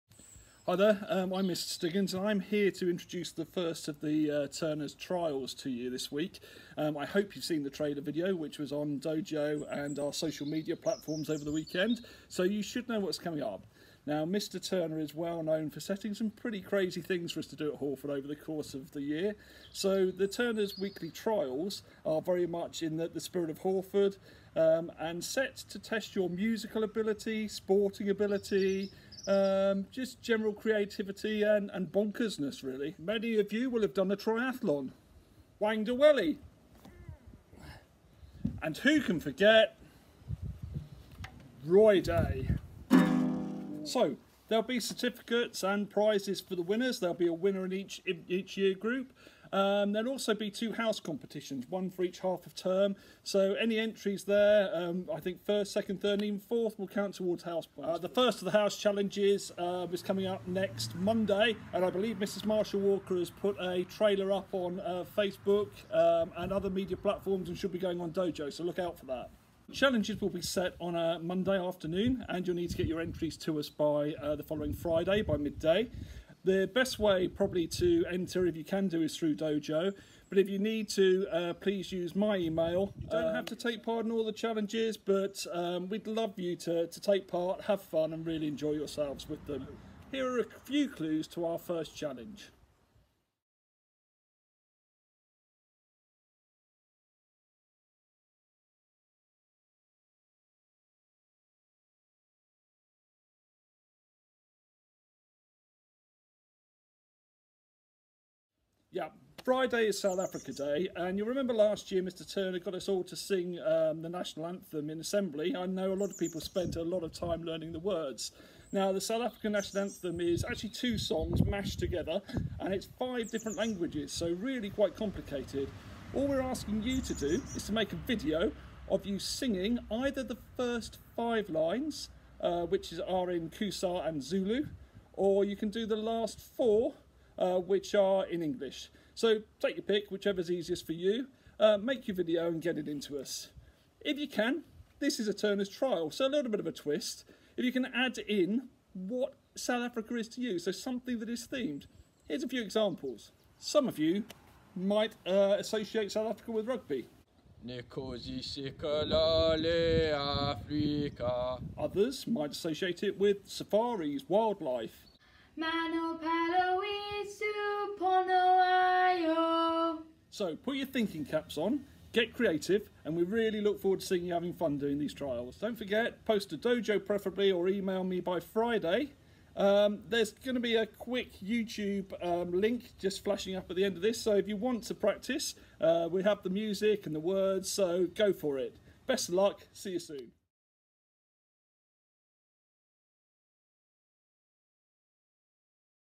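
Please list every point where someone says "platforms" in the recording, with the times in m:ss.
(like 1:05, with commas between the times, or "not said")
0:10, 1:06.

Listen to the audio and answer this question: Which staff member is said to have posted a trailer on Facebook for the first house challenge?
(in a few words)
Mrs Marshall Walker.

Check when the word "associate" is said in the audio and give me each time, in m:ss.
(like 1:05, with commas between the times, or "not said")
2:35, 2:42.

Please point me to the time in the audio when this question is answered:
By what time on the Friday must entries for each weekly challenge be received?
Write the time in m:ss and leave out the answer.
1:15.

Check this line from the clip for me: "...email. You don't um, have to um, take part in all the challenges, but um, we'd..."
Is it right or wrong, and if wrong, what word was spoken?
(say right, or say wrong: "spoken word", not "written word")
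right.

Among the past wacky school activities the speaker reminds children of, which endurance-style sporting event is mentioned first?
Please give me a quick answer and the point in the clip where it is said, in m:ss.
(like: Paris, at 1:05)
triathlon, at 0:34.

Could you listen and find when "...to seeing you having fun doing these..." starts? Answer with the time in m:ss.
2:53.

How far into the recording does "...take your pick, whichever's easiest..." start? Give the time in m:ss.
2:19.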